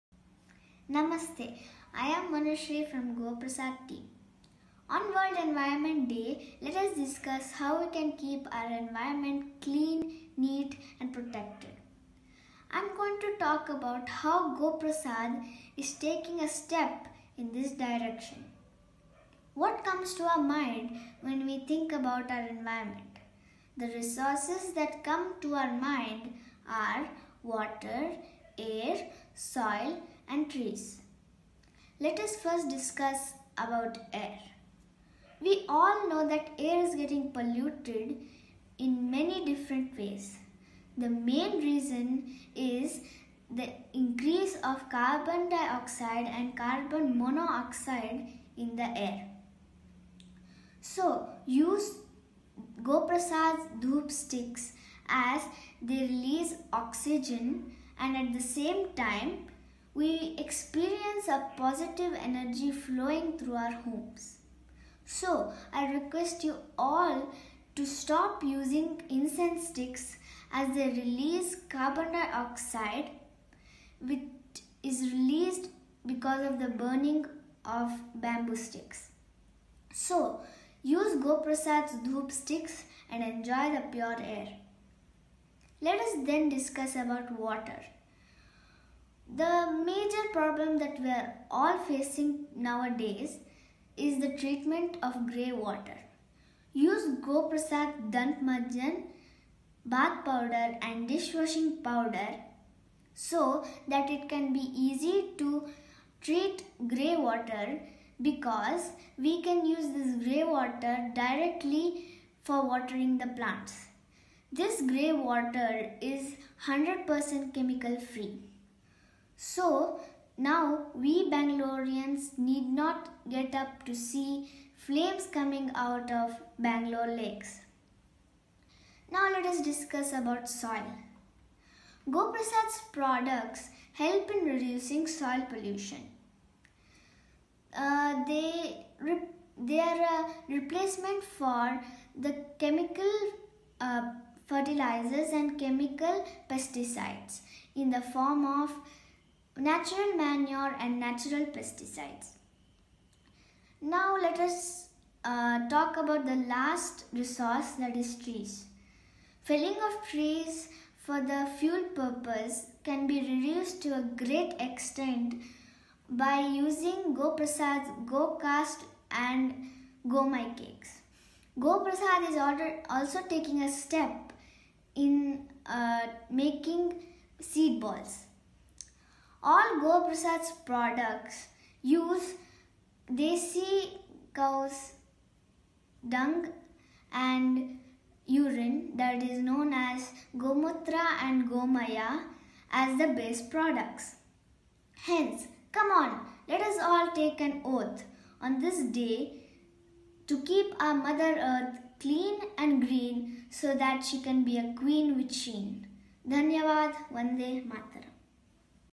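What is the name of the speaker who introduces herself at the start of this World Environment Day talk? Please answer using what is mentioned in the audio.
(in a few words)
Manushree.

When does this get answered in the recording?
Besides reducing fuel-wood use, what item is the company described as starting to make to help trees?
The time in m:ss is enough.
2:57.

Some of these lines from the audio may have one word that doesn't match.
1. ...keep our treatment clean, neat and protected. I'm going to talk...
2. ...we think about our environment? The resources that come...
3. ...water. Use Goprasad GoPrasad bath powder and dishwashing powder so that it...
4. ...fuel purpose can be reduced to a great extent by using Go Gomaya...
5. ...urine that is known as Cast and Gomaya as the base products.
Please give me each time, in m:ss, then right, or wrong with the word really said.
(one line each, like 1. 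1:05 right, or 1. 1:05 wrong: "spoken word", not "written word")
1. 0:08 wrong: "environment", not "treatment"
2. 0:21 right
3. 1:35 wrong: "Dant", not "GoPrasad"
4. 2:41 wrong: "Prasad", not "Gomaya"
5. 3:08 wrong: "Gomutra", not "Cast".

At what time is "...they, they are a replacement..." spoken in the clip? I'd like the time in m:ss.
2:18.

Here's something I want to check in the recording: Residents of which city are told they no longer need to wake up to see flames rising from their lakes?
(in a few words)
Bangalore.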